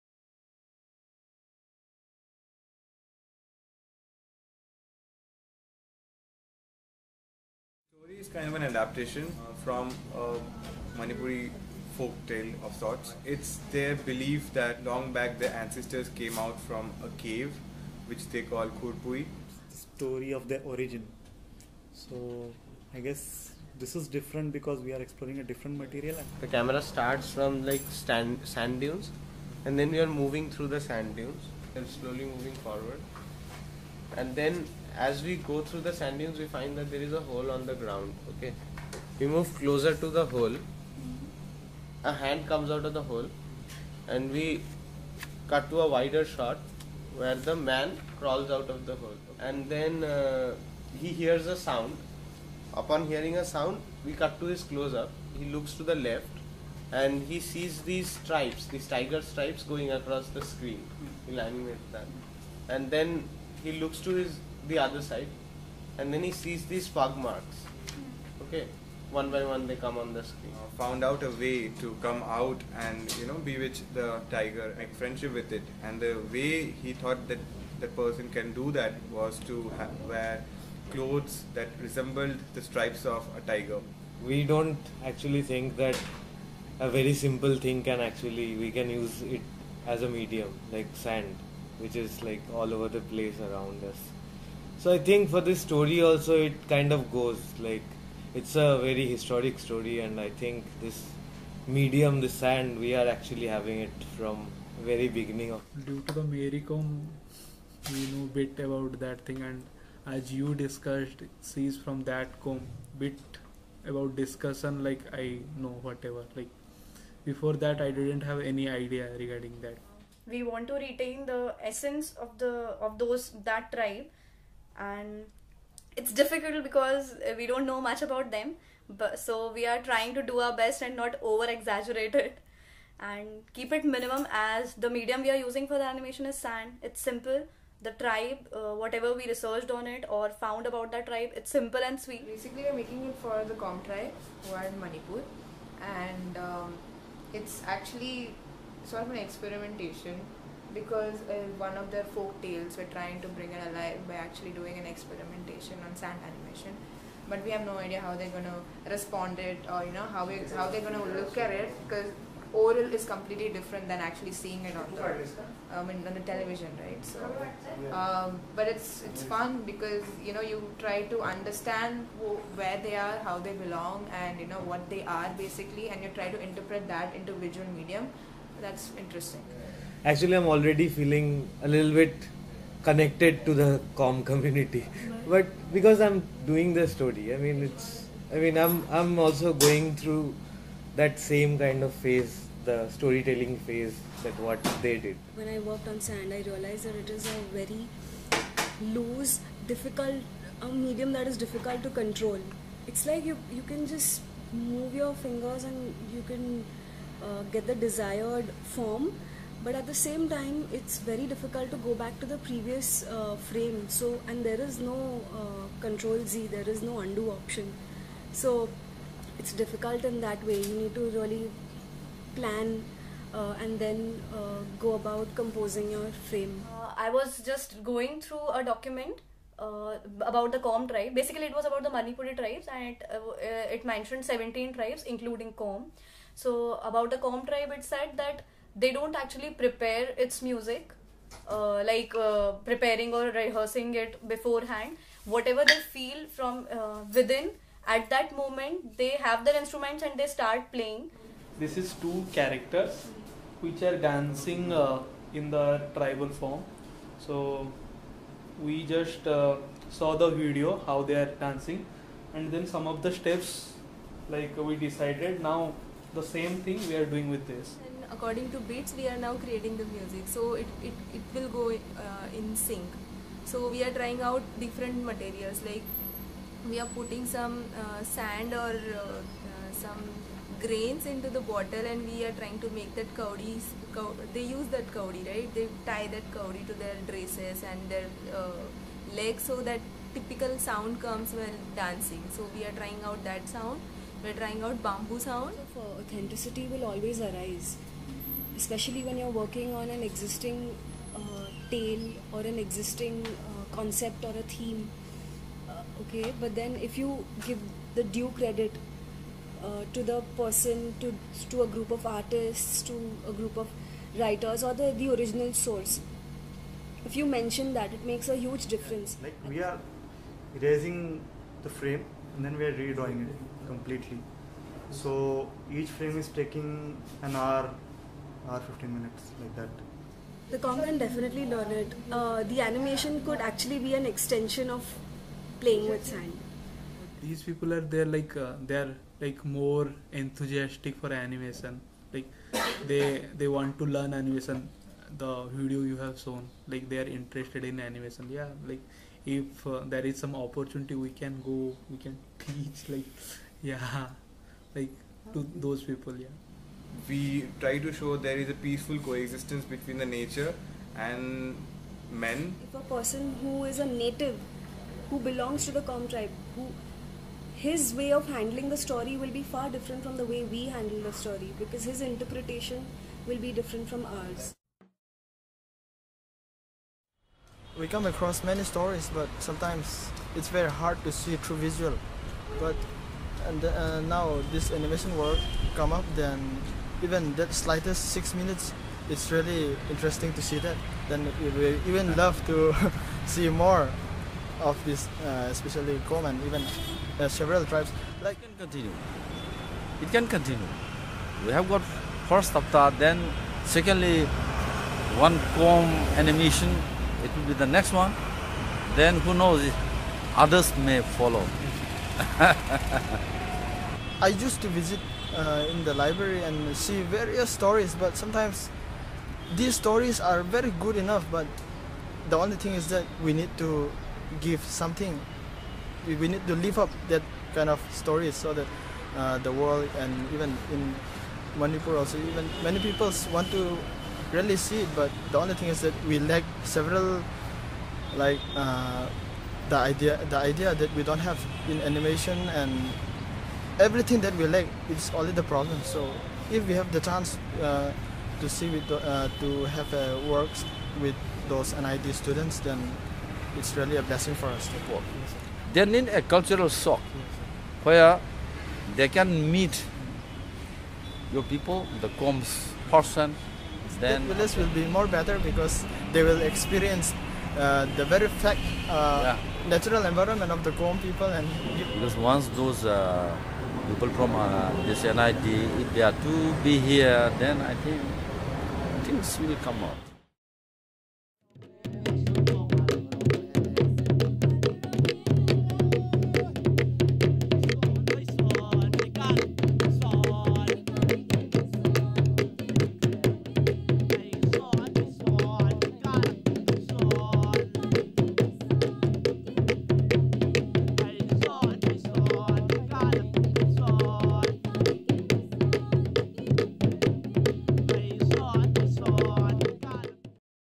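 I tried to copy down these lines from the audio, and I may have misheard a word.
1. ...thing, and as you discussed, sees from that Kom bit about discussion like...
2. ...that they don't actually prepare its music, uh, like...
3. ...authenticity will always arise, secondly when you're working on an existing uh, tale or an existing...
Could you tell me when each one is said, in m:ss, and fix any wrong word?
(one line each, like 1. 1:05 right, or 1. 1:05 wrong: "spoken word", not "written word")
1. 1:49 right
2. 3:58 right
3. 4:55 wrong: "especially", not "secondly".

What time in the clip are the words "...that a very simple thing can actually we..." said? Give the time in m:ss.
1:25.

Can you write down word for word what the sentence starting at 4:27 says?
And according to beats, we are now creating the music.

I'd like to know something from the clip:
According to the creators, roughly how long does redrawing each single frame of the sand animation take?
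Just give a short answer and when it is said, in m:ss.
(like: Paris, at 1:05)
An hour 15 minutes, at 5:28.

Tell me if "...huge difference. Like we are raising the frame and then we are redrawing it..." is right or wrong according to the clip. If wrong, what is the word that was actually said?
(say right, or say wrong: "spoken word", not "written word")
right.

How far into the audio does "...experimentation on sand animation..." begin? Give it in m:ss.
2:34.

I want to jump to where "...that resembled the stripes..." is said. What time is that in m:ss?
1:21.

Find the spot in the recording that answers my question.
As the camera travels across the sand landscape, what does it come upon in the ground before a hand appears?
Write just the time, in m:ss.
0:37.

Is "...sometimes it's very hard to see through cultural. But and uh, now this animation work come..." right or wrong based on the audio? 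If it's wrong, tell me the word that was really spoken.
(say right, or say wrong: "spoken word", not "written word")
wrong: "visual", not "cultural".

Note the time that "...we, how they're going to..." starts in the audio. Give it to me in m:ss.
2:40.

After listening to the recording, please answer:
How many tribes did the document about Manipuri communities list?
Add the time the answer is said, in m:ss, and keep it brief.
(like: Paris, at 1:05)
17, at 3:54.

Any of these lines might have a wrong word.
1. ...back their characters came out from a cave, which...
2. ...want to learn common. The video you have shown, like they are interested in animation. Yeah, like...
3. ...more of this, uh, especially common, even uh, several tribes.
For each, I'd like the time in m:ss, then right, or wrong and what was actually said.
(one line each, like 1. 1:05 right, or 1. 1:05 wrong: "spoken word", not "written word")
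1. 0:15 wrong: "ancestors", not "characters"
2. 5:43 wrong: "animation", not "common"
3. 6:33 right.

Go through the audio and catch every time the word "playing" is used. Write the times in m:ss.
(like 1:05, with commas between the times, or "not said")
4:10, 5:35.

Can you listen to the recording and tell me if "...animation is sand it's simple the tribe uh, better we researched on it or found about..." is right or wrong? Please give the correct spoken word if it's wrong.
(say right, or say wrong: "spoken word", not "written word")
wrong: "whatever", not "better".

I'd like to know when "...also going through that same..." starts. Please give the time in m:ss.
3:09.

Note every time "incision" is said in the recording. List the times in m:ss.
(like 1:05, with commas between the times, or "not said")
not said.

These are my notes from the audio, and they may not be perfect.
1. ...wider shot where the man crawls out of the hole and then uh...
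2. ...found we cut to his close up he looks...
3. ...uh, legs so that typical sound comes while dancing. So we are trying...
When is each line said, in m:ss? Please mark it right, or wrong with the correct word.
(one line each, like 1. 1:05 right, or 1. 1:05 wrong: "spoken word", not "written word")
1. 0:45 right
2. 0:53 wrong: "sound", not "found"
3. 4:48 right.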